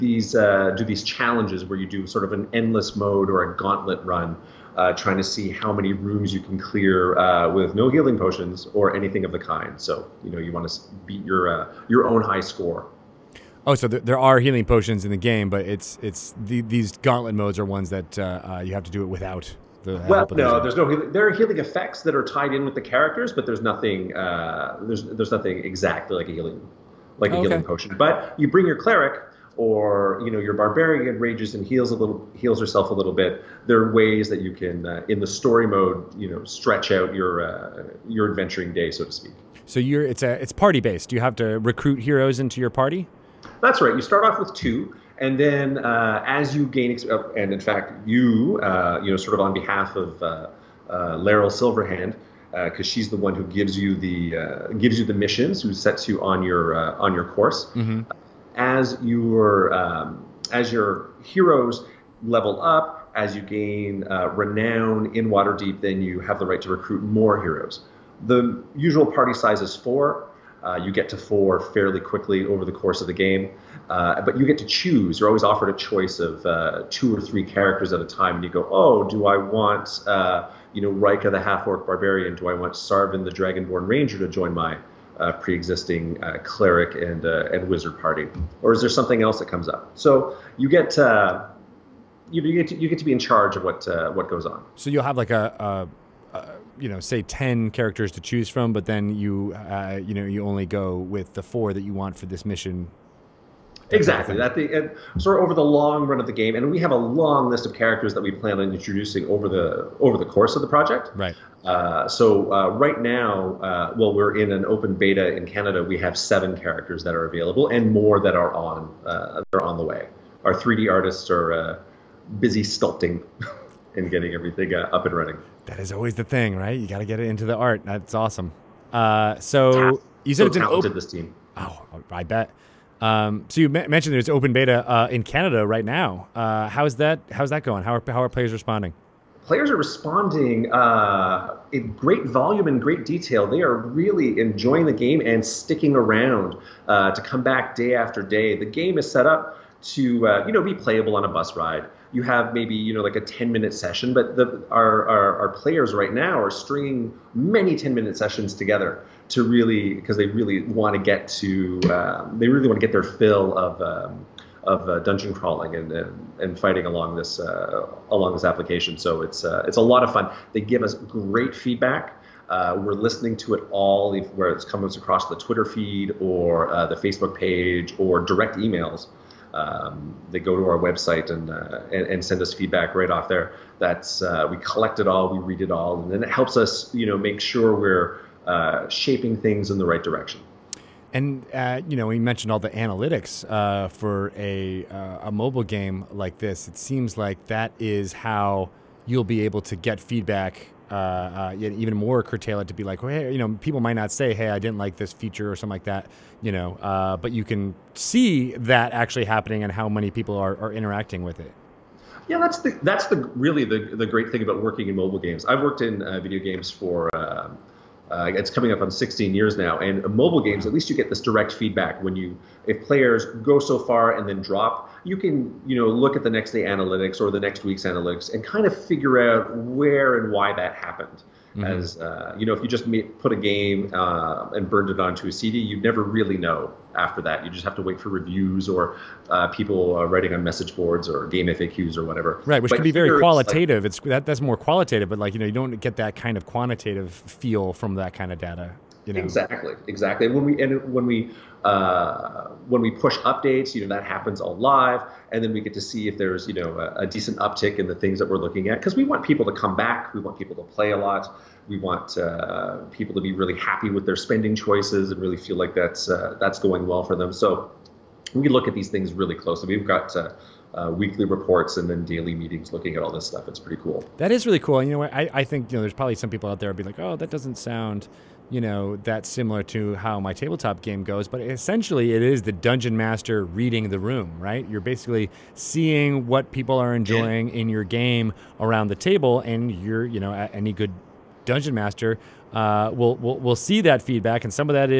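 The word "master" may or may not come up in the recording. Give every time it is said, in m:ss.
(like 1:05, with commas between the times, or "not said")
4:42, 4:51.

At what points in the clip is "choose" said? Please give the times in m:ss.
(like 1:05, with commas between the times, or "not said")
1:14, 1:38.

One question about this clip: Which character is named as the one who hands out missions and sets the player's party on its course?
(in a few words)
Laeral Silverhand.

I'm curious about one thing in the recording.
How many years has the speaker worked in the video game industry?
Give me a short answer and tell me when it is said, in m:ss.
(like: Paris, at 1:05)
16, at 3:38.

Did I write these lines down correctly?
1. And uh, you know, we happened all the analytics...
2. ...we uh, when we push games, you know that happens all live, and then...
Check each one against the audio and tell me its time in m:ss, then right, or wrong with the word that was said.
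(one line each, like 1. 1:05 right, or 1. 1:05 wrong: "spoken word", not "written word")
1. 3:11 wrong: "mentioned", not "happened"
2. 4:11 wrong: "updates", not "games".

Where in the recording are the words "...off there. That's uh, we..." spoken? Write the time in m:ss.
3:03.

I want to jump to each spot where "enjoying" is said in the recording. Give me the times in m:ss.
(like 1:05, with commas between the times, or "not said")
2:24, 4:46.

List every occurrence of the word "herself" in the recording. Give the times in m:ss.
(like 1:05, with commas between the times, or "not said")
0:32.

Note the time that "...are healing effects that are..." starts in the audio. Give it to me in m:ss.
0:21.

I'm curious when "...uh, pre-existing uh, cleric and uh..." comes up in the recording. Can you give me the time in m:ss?
1:25.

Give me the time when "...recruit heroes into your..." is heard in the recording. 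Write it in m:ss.
0:41.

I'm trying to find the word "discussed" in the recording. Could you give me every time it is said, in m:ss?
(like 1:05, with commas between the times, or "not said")
not said.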